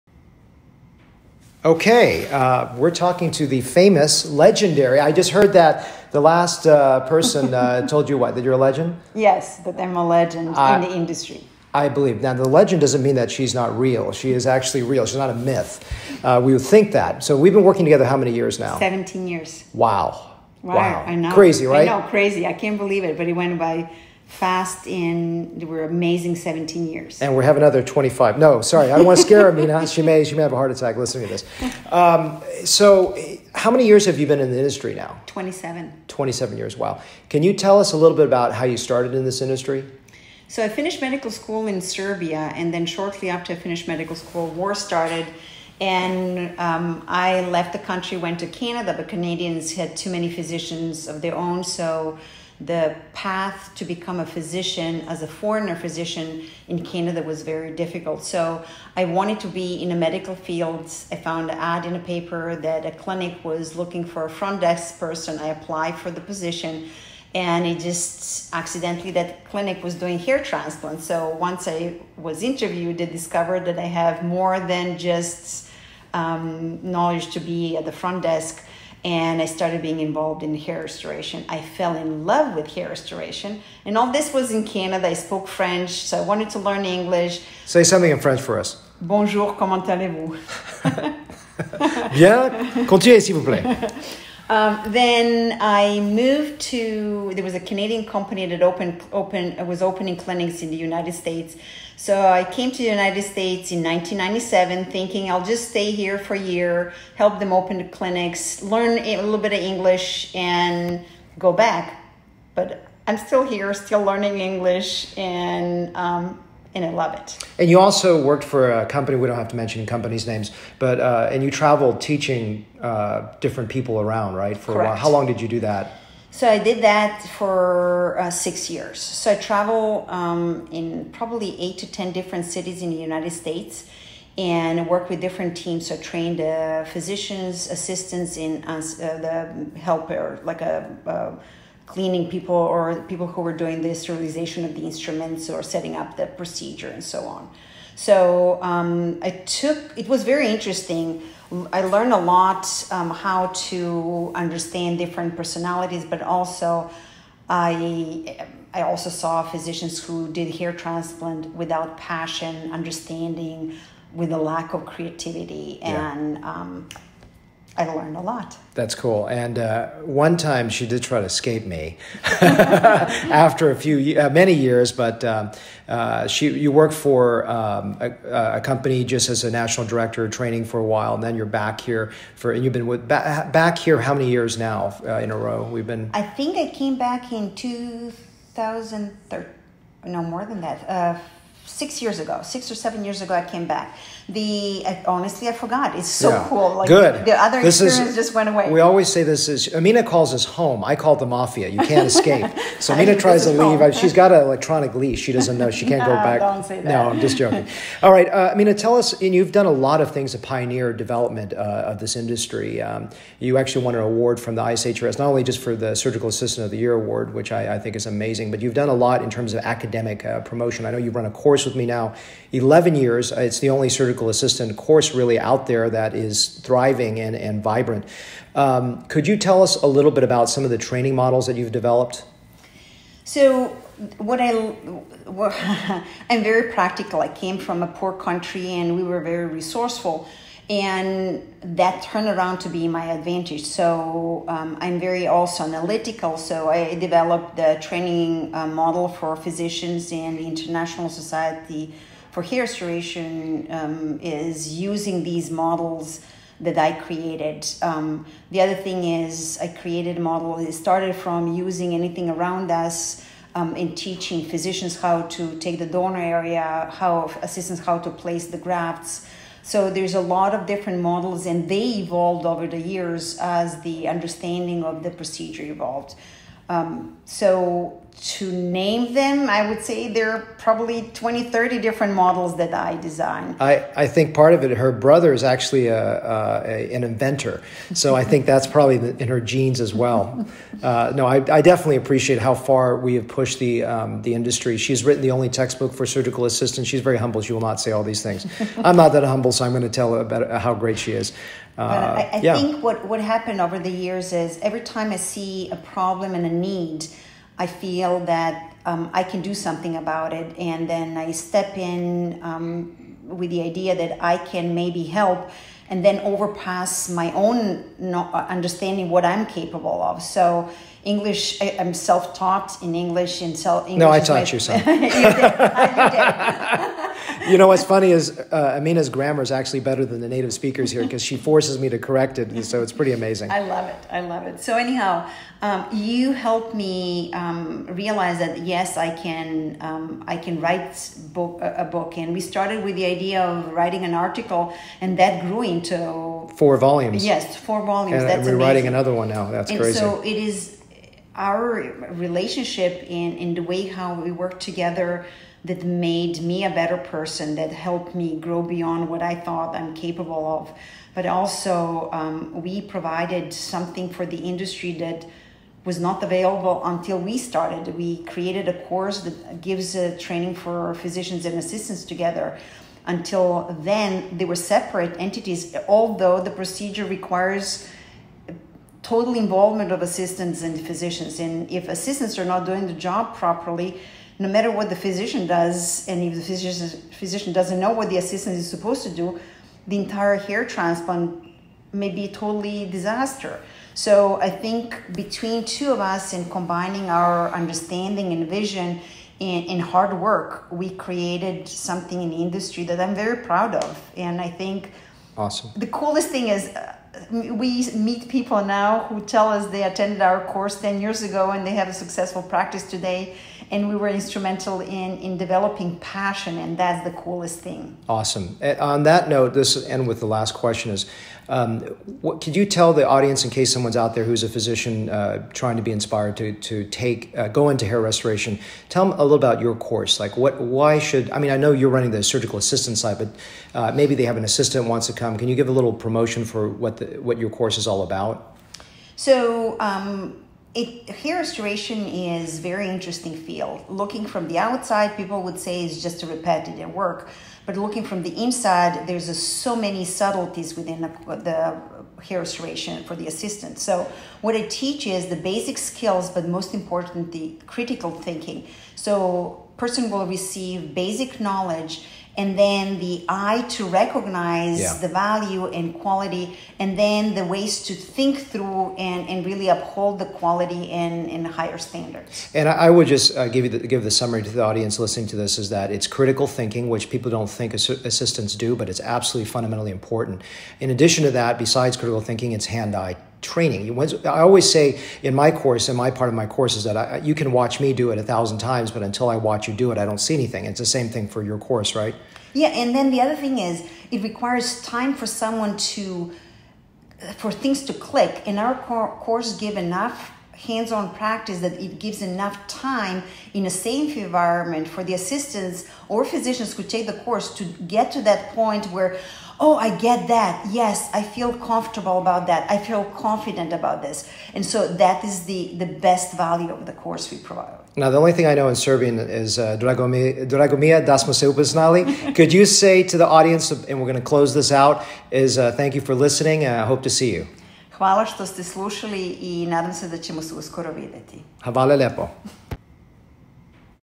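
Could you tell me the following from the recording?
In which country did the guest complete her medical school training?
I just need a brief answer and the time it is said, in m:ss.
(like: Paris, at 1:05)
Serbia, at 0:41.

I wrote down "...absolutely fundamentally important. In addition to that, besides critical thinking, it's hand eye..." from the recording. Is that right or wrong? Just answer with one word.
right.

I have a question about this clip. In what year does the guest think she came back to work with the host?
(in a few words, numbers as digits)
2013.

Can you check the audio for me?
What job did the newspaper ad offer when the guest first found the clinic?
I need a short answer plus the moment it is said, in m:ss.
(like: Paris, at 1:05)
front desk person, at 1:04.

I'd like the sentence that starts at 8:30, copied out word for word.
Yes, I feel comfortable about that.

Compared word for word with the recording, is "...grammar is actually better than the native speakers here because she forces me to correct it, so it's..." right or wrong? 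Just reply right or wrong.
right.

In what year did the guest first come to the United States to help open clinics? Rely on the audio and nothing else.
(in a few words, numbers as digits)
1997.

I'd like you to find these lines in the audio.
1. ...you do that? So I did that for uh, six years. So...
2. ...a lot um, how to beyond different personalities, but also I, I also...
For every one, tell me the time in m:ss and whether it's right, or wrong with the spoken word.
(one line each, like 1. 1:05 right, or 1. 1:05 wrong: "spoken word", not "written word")
1. 2:05 right
2. 2:32 wrong: "understand", not "beyond".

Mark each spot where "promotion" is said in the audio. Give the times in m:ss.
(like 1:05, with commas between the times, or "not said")
3:40, 7:15.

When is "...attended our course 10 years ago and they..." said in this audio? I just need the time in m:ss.
6:49.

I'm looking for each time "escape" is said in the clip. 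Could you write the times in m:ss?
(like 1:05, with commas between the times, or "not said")
2:51, 3:22.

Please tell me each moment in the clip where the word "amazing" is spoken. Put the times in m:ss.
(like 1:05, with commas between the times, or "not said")
0:25, 3:38, 5:33, 5:48.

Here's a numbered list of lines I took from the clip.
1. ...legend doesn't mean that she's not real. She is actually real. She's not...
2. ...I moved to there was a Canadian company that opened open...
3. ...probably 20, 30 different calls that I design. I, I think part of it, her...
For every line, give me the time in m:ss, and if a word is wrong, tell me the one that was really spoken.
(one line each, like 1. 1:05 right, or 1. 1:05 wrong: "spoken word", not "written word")
1. 0:12 right
2. 1:35 right
3. 4:40 wrong: "models", not "calls".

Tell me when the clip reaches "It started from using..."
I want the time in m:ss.
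4:20.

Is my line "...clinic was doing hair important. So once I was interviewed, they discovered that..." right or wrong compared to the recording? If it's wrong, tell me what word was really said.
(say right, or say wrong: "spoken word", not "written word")
wrong: "transplant", not "important".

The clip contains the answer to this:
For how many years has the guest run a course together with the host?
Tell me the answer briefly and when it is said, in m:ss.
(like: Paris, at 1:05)
11 years, at 3:42.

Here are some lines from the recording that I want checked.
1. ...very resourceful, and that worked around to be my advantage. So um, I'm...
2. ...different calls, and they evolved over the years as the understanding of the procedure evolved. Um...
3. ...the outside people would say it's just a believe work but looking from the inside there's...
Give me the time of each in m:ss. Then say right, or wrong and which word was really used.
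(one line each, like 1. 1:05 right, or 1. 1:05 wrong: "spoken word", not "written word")
1. 3:59 wrong: "turned", not "worked"
2. 4:30 wrong: "models", not "calls"
3. 7:24 wrong: "repetitive", not "believe".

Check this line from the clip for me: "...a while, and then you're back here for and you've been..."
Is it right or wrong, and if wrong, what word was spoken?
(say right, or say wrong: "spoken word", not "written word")
right.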